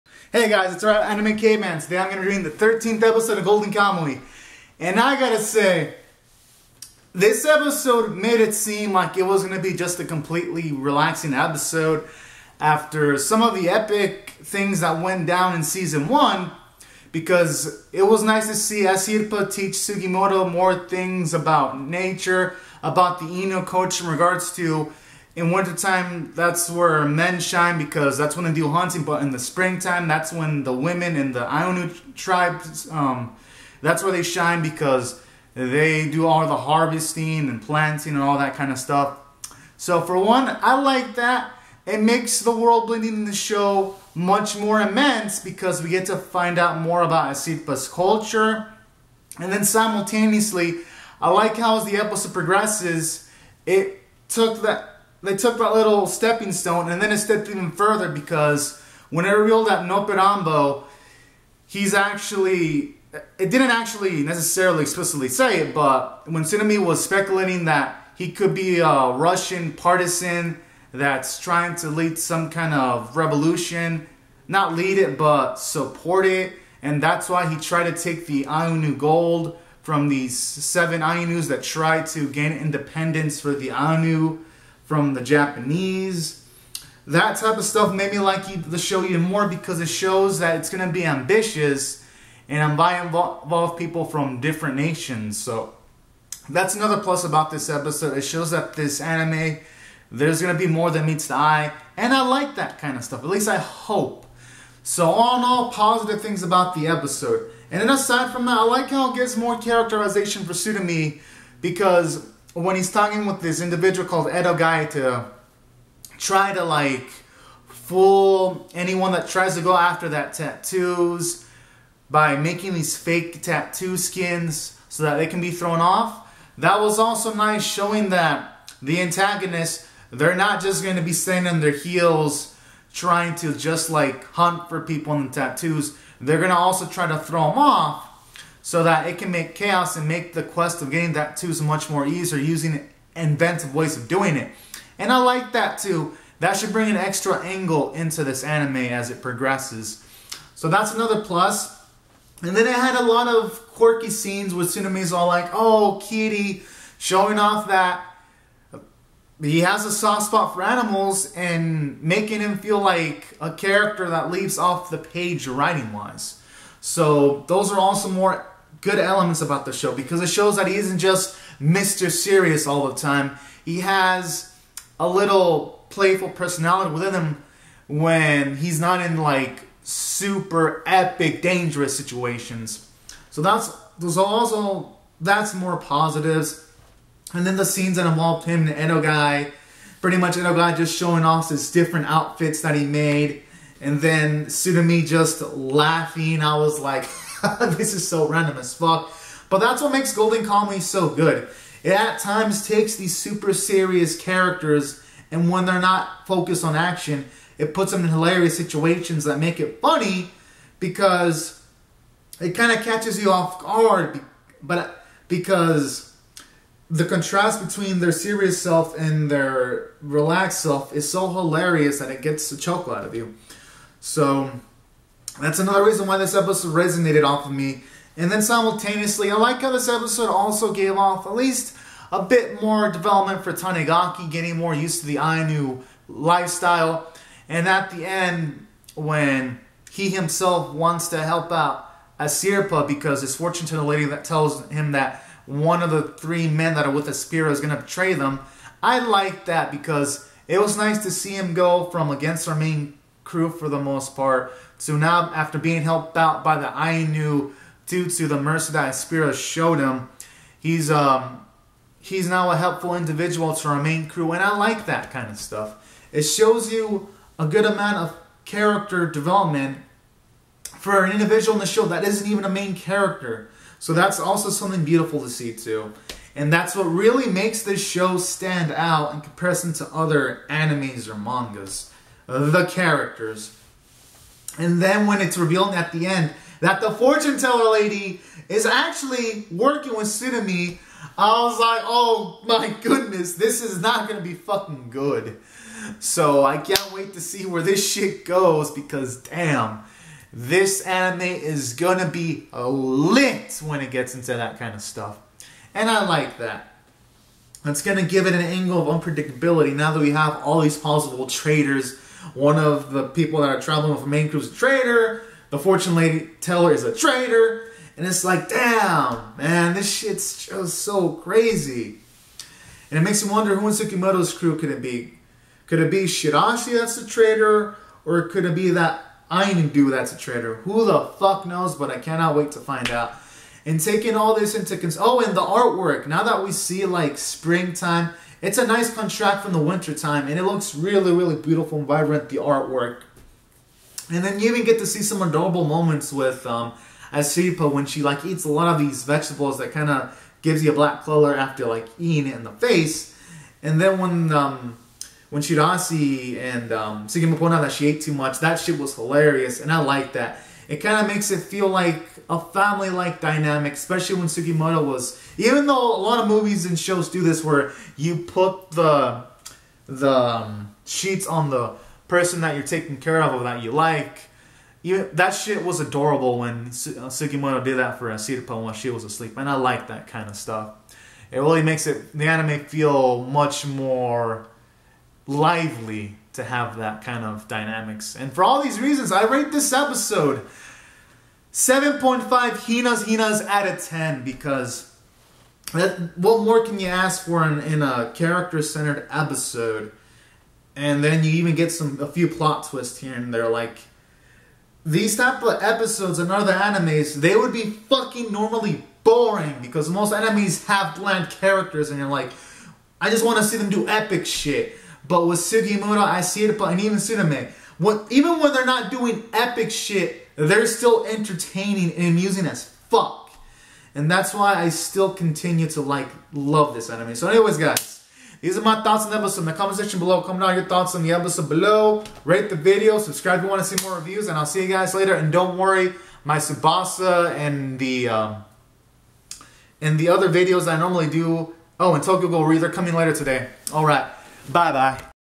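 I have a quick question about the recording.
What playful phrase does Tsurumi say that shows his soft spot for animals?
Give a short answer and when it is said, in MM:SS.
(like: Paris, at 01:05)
oh, kitty, at 02:35.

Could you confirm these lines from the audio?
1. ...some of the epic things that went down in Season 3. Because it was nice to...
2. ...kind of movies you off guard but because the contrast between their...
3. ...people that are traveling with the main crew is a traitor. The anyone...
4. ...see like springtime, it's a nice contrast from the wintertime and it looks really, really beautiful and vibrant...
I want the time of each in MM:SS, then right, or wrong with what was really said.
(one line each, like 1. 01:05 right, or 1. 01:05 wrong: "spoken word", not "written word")
1. 00:13 wrong: "1", not "3"
2. 03:32 wrong: "catches", not "movies"
3. 05:13 wrong: "fortune", not "anyone"
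4. 05:36 right.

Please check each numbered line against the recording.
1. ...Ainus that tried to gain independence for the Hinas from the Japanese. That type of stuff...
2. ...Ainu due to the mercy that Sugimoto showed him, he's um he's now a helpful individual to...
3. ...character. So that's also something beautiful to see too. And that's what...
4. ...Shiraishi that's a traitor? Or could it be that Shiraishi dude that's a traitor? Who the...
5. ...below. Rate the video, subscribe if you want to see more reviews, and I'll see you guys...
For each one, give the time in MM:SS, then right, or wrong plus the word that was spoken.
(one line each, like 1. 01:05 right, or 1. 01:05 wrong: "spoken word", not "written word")
1. 01:21 wrong: "Ainu", not "Hinas"
2. 04:16 wrong: "Spira", not "Sugimoto"
3. 04:32 right
4. 05:26 wrong: "Ainu", not "Shiraishi"
5. 07:11 right.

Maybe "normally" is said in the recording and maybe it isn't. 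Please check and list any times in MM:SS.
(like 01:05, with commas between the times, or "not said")
06:48, 07:20.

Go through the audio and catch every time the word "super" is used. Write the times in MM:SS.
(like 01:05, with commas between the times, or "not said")
02:59, 03:23.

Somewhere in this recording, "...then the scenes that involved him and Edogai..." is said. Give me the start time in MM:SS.
03:07.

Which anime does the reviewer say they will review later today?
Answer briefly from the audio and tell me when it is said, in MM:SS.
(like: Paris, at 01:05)
Tokyo Ghoul:re, at 07:22.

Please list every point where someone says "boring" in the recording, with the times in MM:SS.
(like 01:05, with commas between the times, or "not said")
06:49.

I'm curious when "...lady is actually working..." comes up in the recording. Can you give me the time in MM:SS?
04:47.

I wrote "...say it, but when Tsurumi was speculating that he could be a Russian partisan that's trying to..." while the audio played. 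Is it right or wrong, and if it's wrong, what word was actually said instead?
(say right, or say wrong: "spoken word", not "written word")
right.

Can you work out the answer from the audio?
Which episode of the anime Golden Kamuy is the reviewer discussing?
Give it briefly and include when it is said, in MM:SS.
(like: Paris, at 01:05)
13th, at 00:02.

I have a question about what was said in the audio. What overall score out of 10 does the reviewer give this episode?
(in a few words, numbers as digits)
7.5.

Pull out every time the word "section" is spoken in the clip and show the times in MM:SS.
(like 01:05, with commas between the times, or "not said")
07:09.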